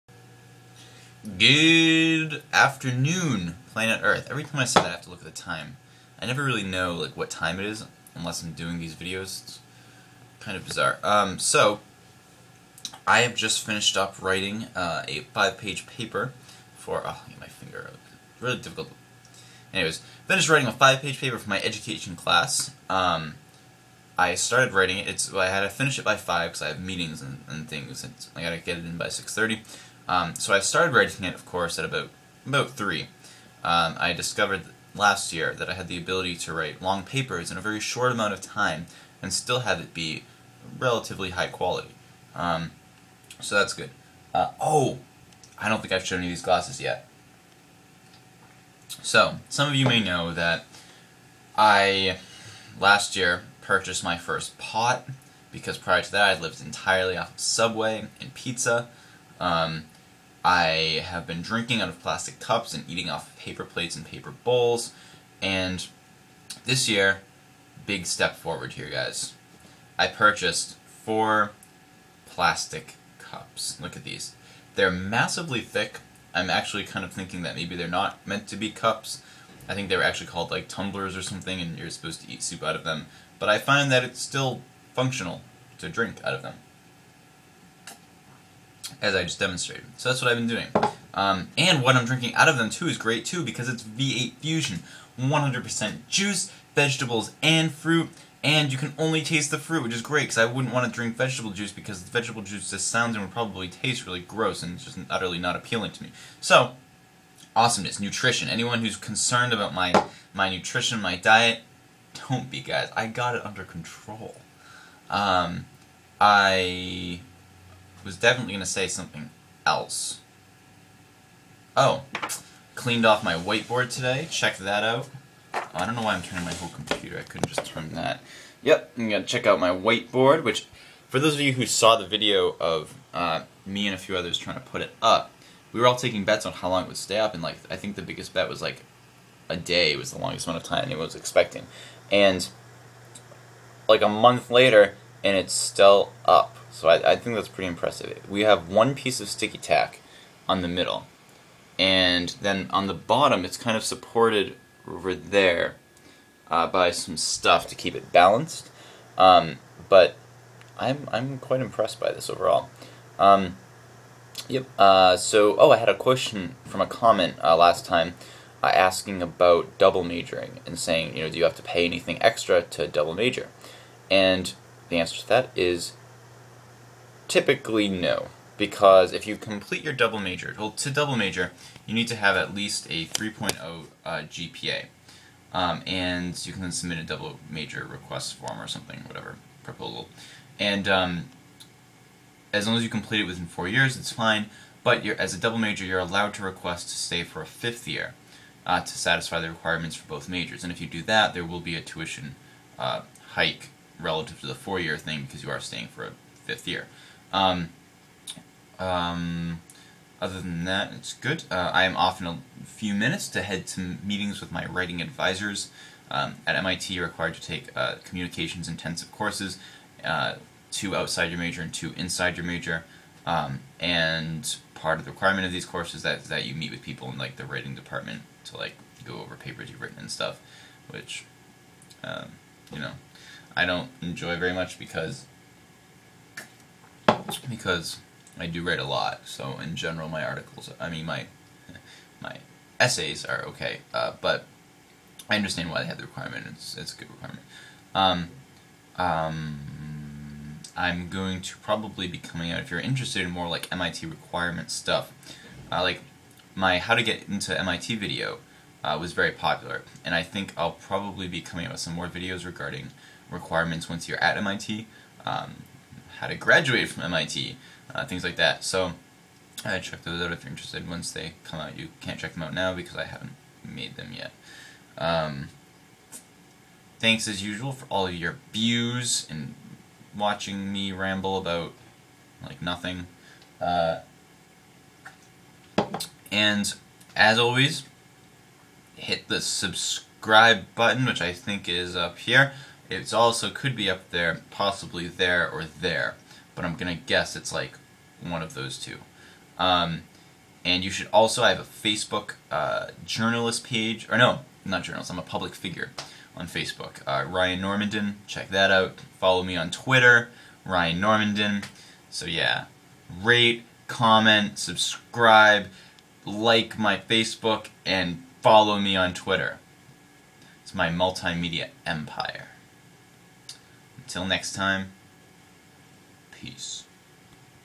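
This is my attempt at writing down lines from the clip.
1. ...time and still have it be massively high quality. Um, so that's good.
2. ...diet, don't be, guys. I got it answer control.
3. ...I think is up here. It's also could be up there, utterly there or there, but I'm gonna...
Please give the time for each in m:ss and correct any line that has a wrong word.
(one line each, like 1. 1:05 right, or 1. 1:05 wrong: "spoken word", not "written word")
1. 0:38 wrong: "relatively", not "massively"
2. 1:51 wrong: "under", not "answer"
3. 4:51 wrong: "possibly", not "utterly".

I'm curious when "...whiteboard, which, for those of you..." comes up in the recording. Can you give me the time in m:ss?
2:09.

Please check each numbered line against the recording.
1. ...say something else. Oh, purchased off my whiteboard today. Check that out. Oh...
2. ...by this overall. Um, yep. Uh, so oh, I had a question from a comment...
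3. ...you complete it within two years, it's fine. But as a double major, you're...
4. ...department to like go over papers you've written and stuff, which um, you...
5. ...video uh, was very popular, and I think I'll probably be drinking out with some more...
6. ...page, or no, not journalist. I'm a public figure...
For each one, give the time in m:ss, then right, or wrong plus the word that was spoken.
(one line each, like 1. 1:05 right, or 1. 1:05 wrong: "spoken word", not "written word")
1. 1:58 wrong: "cleaned", not "purchased"
2. 2:41 right
3. 3:12 wrong: "four", not "two"
4. 3:47 right
5. 4:17 wrong: "coming", not "drinking"
6. 5:03 right.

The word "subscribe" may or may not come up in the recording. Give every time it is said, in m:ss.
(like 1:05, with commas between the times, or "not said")
4:49, 5:14.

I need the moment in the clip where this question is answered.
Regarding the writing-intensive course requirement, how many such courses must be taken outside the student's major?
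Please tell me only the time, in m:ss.
3:40.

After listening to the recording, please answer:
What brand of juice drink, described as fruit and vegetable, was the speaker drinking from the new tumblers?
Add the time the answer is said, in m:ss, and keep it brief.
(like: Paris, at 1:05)
V8 Fusion, at 1:33.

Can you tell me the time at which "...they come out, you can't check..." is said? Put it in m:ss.
4:31.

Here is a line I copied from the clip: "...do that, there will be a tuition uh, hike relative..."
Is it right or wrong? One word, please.
right.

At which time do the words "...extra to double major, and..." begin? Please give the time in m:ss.
2:52.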